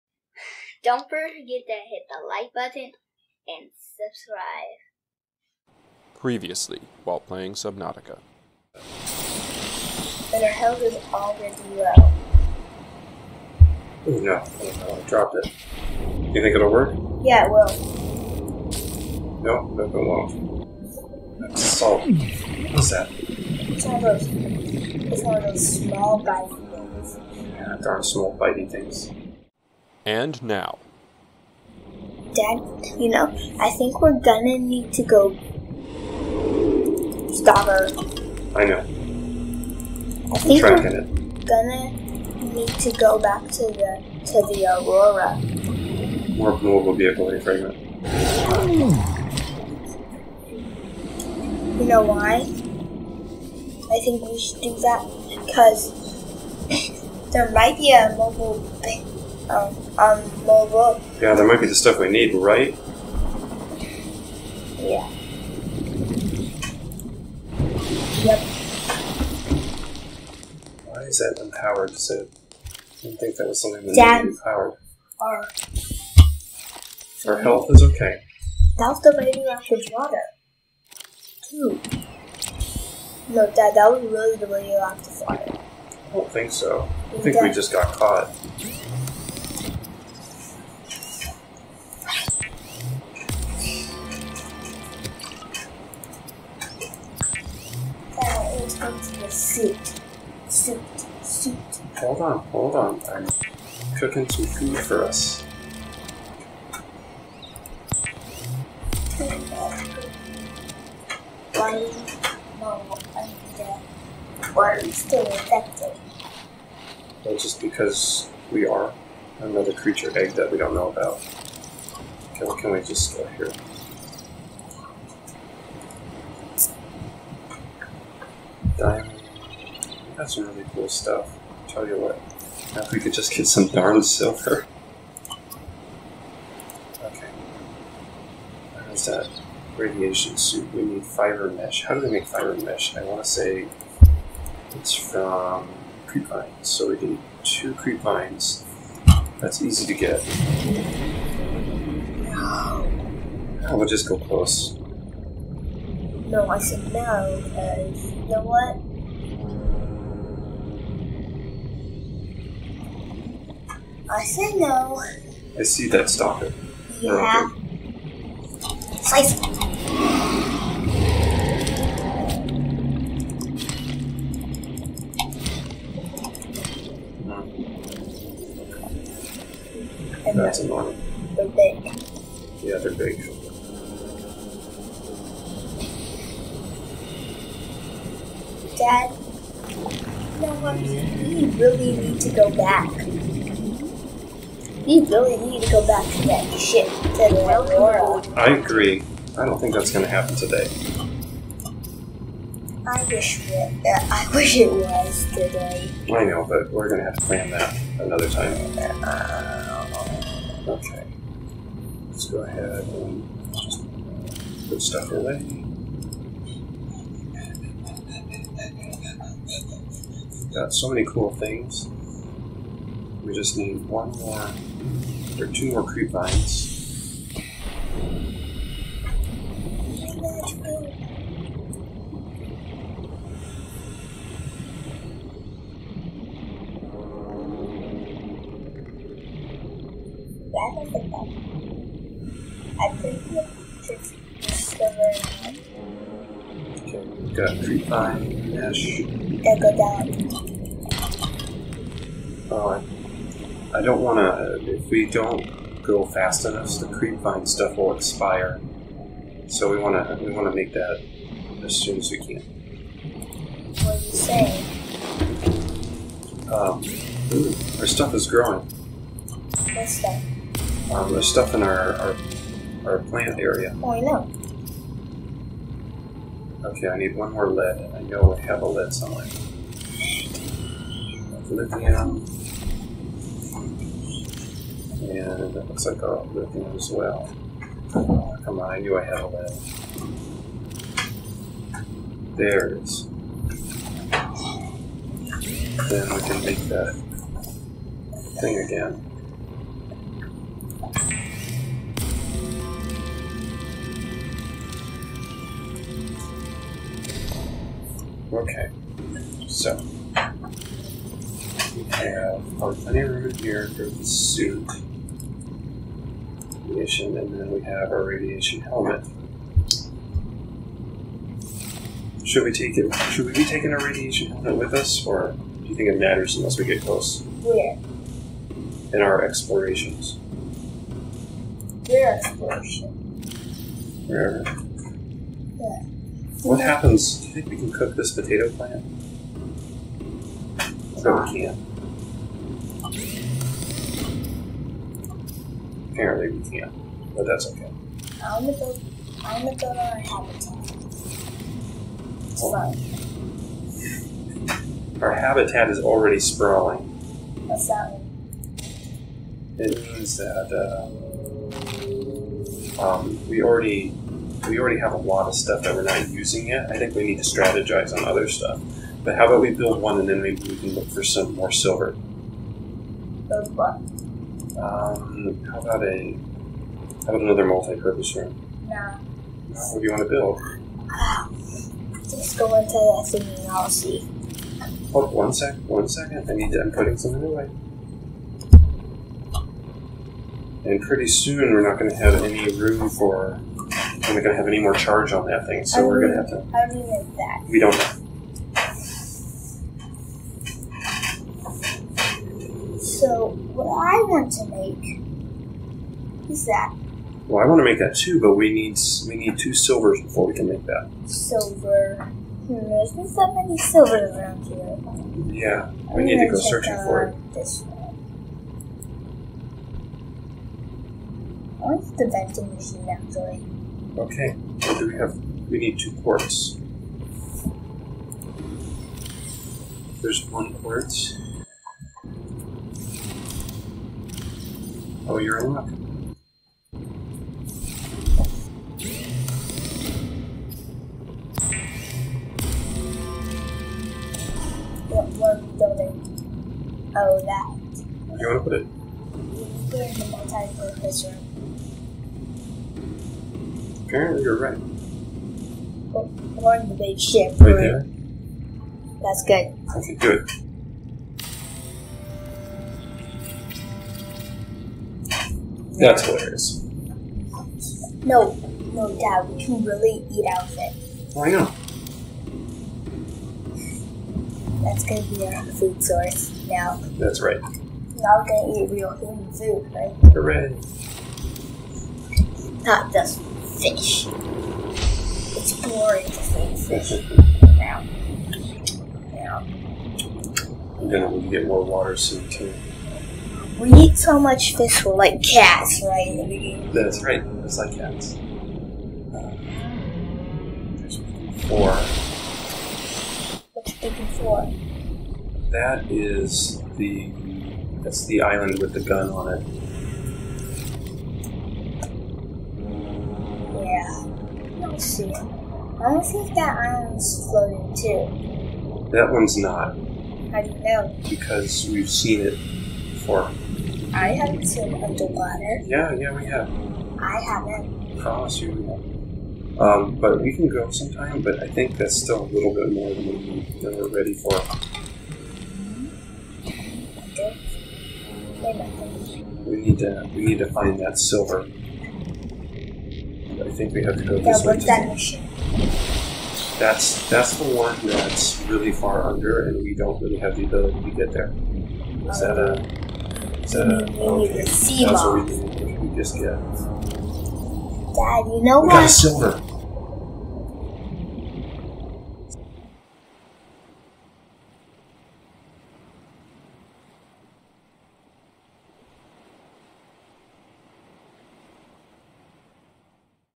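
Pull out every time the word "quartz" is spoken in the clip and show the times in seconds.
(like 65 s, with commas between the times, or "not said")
426 s, 430 s.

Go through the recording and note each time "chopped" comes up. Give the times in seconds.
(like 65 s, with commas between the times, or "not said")
not said.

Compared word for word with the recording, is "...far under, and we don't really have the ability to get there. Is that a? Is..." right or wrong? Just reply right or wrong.
right.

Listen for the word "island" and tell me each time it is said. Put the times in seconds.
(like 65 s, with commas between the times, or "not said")
508 s, 516 s.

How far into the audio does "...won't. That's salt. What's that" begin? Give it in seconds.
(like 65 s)
19 s.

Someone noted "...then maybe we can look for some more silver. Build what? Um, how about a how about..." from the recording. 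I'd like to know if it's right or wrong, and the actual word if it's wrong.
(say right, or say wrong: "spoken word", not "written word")
right.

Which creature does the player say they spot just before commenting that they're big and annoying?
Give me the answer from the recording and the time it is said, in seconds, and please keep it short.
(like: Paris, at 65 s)
stalker, at 166 s.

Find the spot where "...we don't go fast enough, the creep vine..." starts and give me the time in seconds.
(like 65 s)
254 s.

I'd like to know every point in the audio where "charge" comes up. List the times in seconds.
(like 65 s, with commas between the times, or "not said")
394 s.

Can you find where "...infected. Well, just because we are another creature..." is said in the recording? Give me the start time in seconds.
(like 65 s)
115 s.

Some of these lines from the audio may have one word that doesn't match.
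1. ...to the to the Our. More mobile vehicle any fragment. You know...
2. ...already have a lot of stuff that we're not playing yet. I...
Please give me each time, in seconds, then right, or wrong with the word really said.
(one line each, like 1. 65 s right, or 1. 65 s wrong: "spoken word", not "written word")
1. 43 s wrong: "Aurora", not "Our"
2. 364 s wrong: "using", not "playing".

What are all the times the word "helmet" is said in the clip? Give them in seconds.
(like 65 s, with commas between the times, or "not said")
318 s, 324 s.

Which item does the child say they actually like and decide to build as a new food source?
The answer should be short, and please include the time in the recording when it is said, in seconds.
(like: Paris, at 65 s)
vending machine, at 422 s.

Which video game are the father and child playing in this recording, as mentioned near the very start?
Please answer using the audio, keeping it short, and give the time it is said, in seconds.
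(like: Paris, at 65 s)
Subnautica, at 7 s.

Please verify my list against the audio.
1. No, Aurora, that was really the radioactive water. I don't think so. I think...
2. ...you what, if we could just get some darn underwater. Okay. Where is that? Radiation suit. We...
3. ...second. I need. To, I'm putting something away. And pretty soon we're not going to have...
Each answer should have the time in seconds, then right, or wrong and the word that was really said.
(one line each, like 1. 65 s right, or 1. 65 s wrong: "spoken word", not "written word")
1. 83 s wrong: "Dad", not "Aurora"
2. 131 s wrong: "silver", not "underwater"
3. 385 s right.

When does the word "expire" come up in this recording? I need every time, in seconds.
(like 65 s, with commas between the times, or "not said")
257 s.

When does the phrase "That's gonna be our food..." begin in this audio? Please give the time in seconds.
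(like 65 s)
474 s.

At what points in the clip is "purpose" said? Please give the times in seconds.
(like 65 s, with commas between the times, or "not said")
377 s, 450 s.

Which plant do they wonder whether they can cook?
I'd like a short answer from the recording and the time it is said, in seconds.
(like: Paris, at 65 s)
potato plant, at 338 s.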